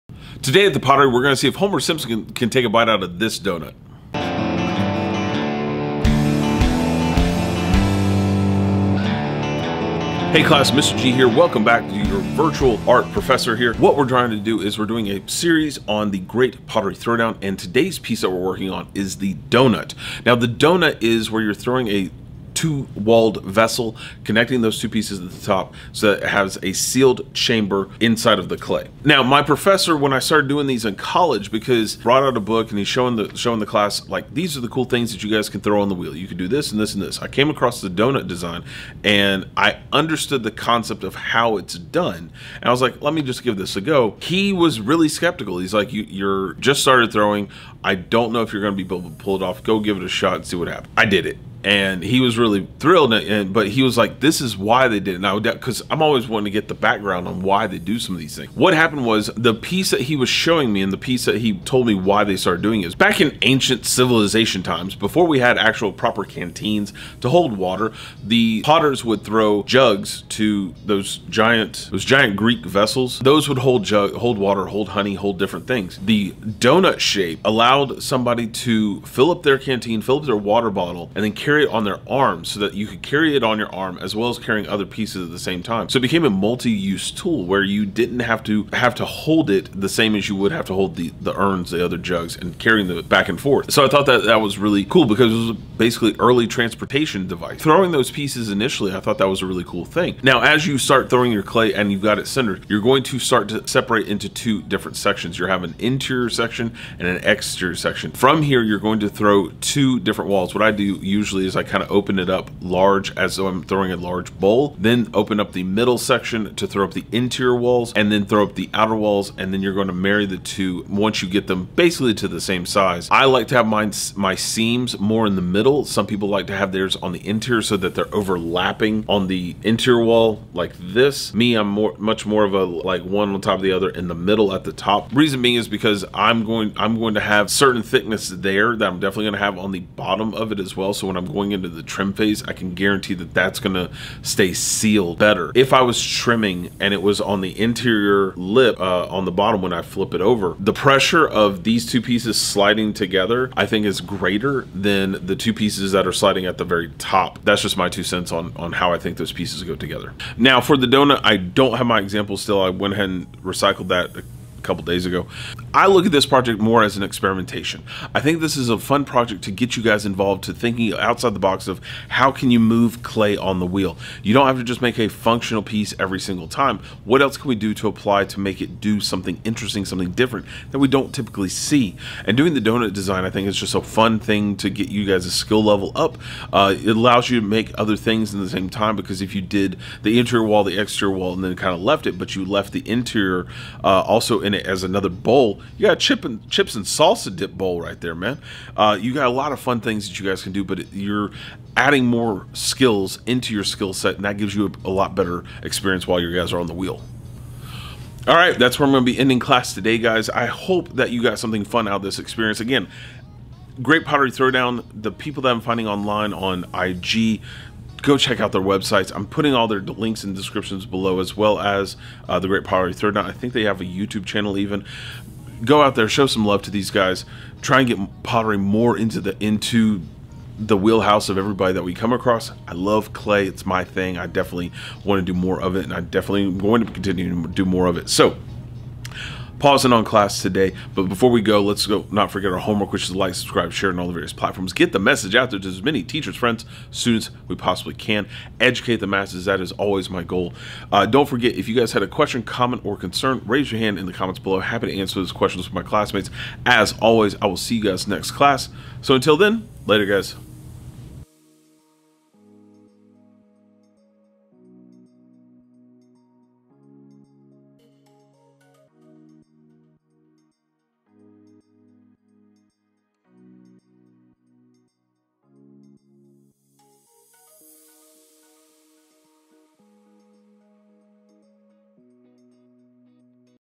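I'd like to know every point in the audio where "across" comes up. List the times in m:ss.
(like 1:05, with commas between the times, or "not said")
0:37, 3:52.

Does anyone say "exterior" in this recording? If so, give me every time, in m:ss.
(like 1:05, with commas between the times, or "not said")
1:47, 3:10.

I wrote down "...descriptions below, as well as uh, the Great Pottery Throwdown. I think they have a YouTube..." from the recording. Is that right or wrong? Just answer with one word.
right.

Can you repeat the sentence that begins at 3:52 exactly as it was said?
I love clay; it's my thing.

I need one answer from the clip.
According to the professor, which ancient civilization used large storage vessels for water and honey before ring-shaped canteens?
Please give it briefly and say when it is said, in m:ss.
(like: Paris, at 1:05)
Greek, at 1:12.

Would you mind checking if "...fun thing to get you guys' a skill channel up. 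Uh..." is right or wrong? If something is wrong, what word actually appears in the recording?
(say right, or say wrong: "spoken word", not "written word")
wrong: "level", not "channel".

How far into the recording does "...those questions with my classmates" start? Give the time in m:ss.
4:15.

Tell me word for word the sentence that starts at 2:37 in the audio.
That's just my two cents on, on how I think those pieces go together.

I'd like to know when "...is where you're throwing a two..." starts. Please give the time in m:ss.
0:21.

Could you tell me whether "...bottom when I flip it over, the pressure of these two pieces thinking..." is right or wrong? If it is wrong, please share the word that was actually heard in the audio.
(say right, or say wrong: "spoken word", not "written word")
wrong: "sliding", not "thinking".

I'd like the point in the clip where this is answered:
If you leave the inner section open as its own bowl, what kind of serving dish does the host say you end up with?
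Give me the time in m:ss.
3:16.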